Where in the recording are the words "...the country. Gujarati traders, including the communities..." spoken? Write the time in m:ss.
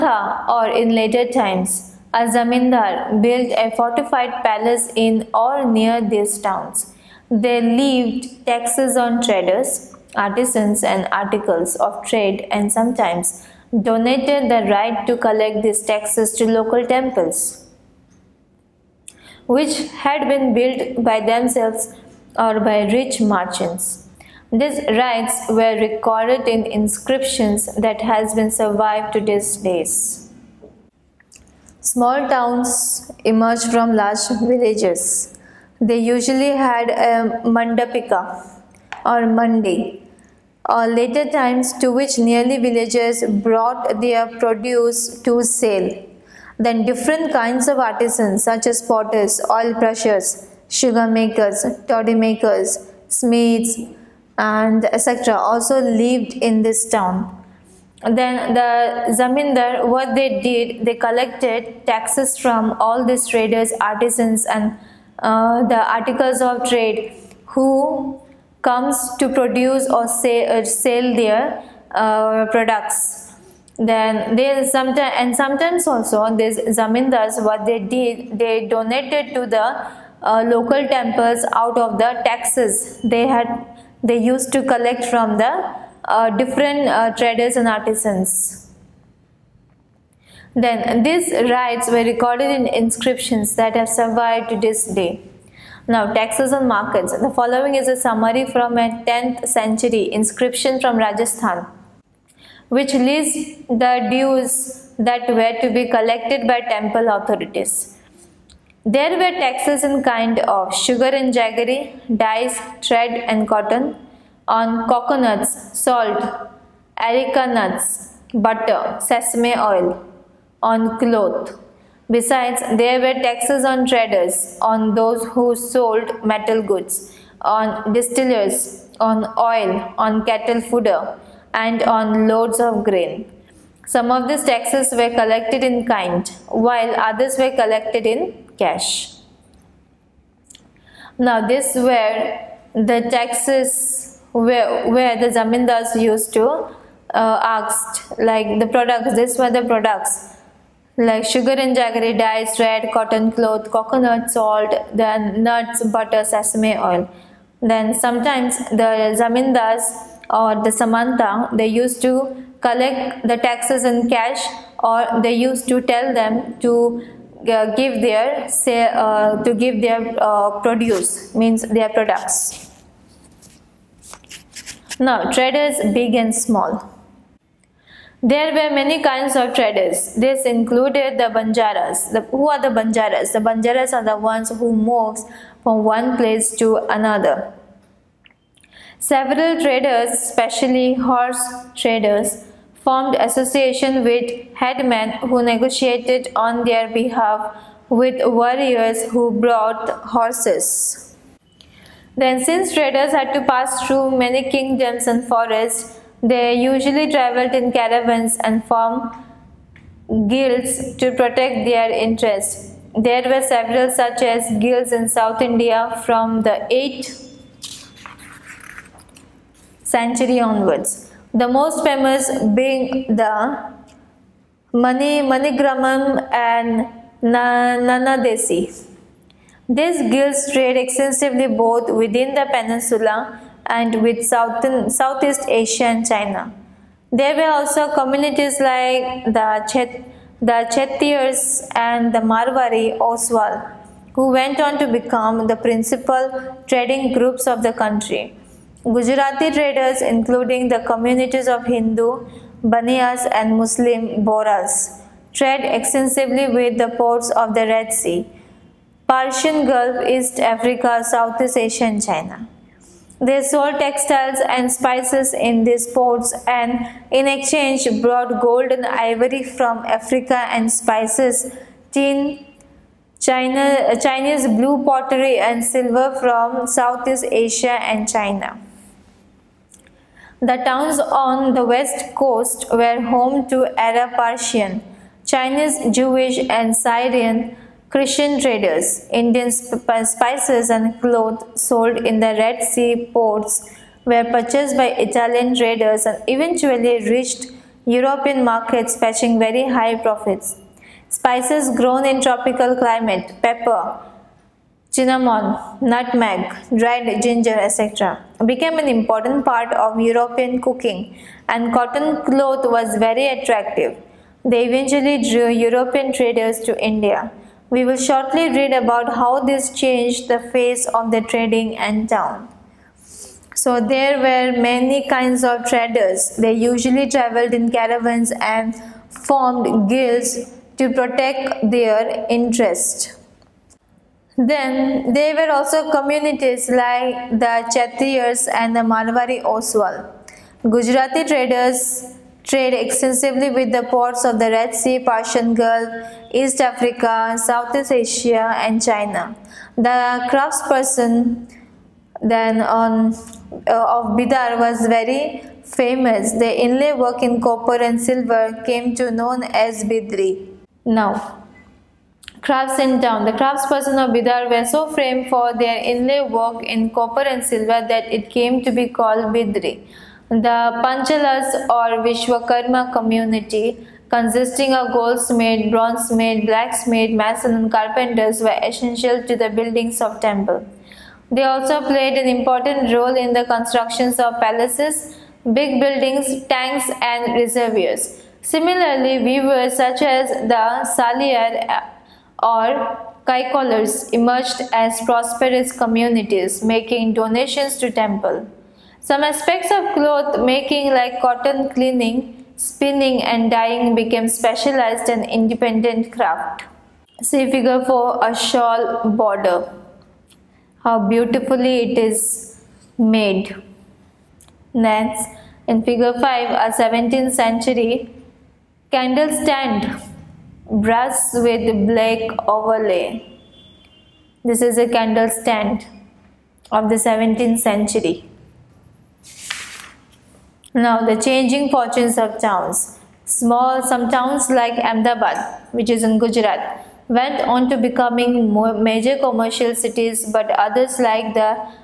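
4:07.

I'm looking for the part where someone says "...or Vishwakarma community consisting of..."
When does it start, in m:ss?
6:11.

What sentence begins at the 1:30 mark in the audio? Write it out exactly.
Then these rites were recorded in inscriptions that have survived to this day.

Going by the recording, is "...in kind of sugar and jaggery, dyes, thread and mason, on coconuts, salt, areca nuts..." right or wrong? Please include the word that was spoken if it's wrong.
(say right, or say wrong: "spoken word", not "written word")
wrong: "cotton", not "mason".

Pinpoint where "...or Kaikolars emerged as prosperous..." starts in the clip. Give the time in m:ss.
6:32.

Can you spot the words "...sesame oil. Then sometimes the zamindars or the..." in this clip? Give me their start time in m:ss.
2:36.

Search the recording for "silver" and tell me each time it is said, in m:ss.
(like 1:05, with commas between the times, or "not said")
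4:35, 5:58, 6:07.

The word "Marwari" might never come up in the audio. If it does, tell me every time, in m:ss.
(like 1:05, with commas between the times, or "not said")
4:02, 5:38.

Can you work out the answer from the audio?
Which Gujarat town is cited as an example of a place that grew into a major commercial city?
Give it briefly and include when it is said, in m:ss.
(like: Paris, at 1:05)
Ahmedabad, at 7:14.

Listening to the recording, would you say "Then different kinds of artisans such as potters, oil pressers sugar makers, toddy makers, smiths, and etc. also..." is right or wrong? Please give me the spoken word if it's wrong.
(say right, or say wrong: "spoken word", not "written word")
right.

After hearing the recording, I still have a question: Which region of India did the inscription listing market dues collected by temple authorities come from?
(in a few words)
Rajasthan.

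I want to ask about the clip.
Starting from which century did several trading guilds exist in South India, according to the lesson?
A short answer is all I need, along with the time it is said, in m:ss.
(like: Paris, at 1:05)
8th century, at 3:36.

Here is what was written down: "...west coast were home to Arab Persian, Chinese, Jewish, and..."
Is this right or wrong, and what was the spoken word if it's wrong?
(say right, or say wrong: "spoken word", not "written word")
right.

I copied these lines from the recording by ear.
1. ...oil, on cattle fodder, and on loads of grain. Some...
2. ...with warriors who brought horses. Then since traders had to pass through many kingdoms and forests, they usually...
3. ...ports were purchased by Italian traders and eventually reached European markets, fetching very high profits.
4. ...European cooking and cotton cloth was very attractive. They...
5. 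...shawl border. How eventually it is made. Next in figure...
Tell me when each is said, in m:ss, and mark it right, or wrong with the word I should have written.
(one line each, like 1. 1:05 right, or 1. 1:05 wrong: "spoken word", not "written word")
1. 2:09 right
2. 3:17 right
3. 4:53 right
4. 5:09 right
5. 6:48 wrong: "beautifully", not "eventually".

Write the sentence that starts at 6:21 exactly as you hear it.
They also played an important role in the constructions of palaces, big buildings, tanks and reservoirs.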